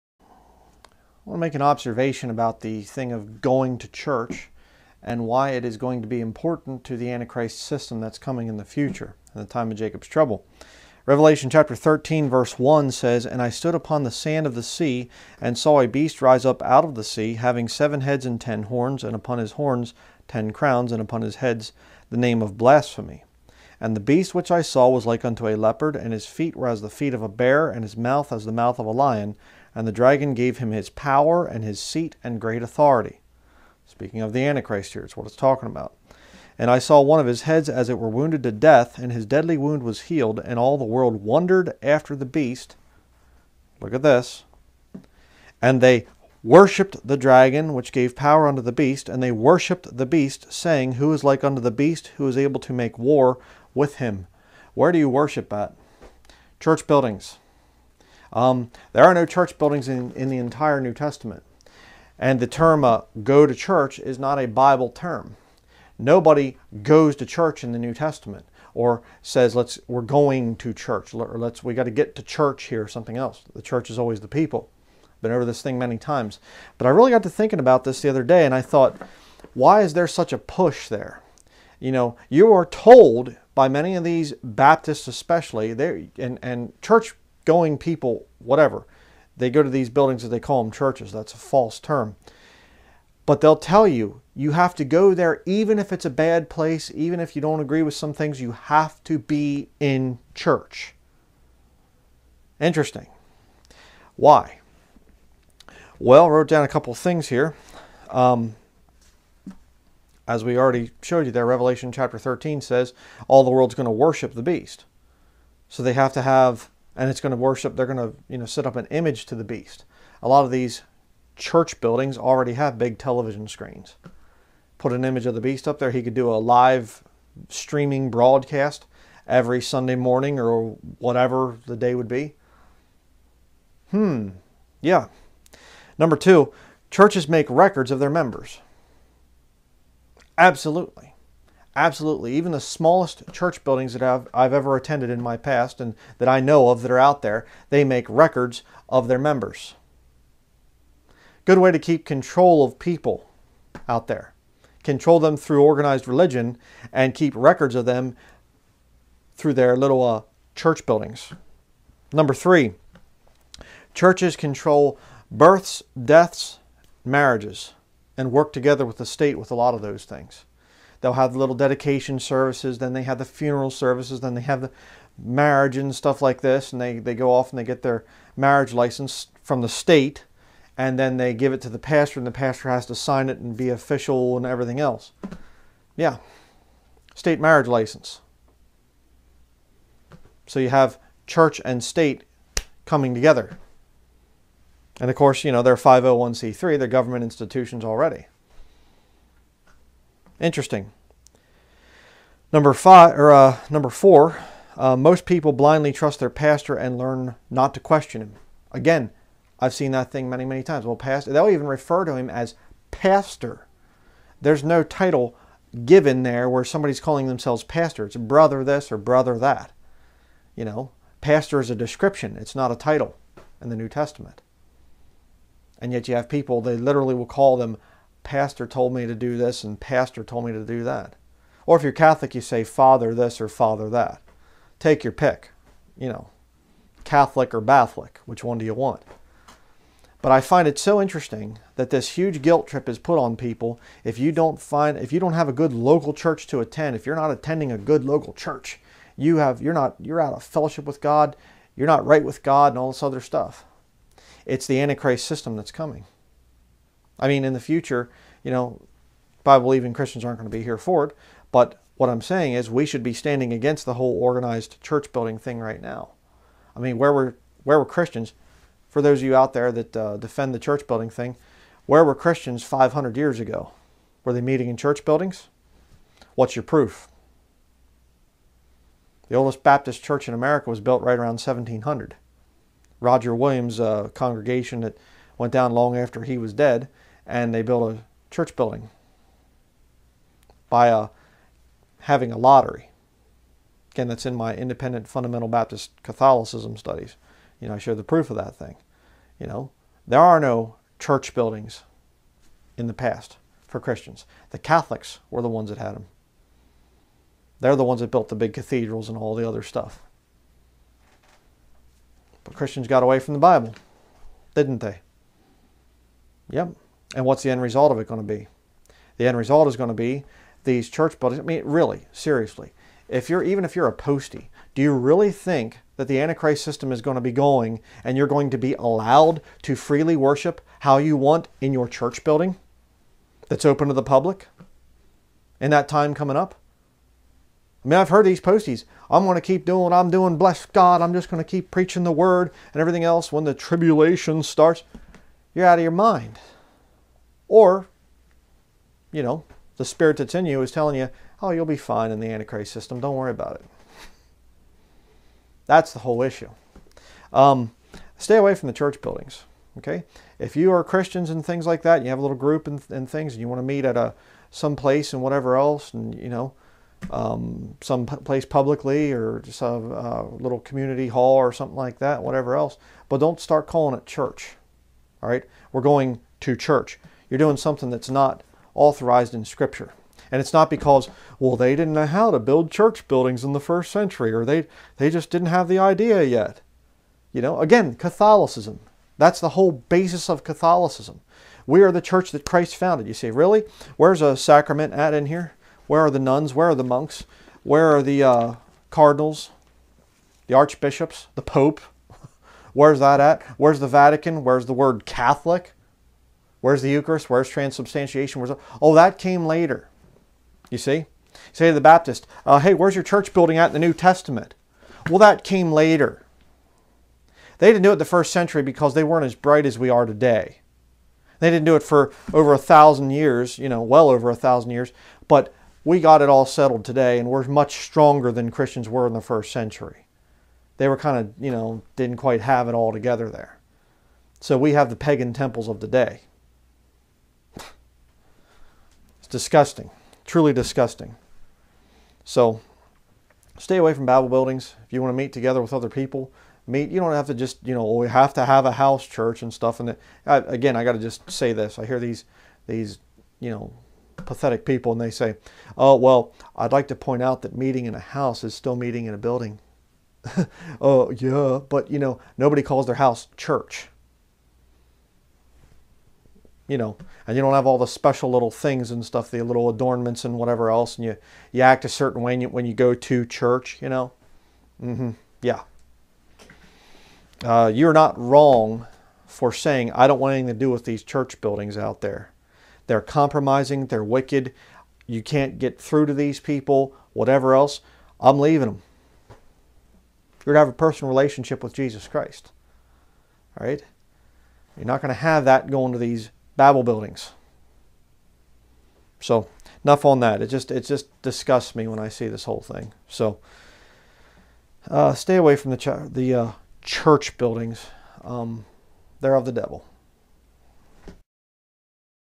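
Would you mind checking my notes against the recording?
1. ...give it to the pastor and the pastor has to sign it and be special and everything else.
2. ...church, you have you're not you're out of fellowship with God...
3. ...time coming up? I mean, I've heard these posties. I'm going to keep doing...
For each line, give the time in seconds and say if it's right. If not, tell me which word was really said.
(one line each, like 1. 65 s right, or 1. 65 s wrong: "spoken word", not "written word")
1. 181 s wrong: "official", not "special"
2. 248 s right
3. 335 s right.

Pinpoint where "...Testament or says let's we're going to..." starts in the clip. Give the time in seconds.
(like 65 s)
67 s.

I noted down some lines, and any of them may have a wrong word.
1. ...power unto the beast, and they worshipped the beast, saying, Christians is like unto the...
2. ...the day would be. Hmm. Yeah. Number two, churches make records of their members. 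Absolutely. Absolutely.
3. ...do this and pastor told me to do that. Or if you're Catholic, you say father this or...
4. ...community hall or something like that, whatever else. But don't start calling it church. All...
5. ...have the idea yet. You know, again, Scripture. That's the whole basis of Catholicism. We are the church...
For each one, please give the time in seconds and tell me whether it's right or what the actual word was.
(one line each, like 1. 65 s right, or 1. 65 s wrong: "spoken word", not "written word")
1. 48 s wrong: "Who", not "Christians"
2. 131 s right
3. 229 s right
4. 370 s right
5. 385 s wrong: "Catholicism", not "Scripture".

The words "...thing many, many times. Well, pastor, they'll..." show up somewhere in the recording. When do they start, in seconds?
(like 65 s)
210 s.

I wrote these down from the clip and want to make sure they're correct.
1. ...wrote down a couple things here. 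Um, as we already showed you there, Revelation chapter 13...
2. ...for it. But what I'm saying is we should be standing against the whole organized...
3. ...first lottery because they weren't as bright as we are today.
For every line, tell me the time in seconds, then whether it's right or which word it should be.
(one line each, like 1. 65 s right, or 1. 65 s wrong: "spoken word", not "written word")
1. 106 s right
2. 260 s right
3. 418 s wrong: "century", not "lottery".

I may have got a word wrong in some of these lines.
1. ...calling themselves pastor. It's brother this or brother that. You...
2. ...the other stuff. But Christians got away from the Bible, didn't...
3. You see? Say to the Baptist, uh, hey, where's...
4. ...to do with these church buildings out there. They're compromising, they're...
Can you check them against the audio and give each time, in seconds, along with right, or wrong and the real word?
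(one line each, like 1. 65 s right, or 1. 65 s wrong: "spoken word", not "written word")
1. 216 s right
2. 309 s right
3. 410 s right
4. 480 s right.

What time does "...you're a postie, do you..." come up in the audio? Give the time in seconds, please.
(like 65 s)
323 s.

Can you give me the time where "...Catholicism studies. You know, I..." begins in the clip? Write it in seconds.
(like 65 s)
296 s.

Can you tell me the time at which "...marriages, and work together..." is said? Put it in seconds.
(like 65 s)
167 s.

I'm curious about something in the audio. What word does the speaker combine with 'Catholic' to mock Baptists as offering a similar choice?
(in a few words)
Batholic.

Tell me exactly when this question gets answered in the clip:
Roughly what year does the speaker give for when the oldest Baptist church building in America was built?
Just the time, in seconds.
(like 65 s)
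281 s.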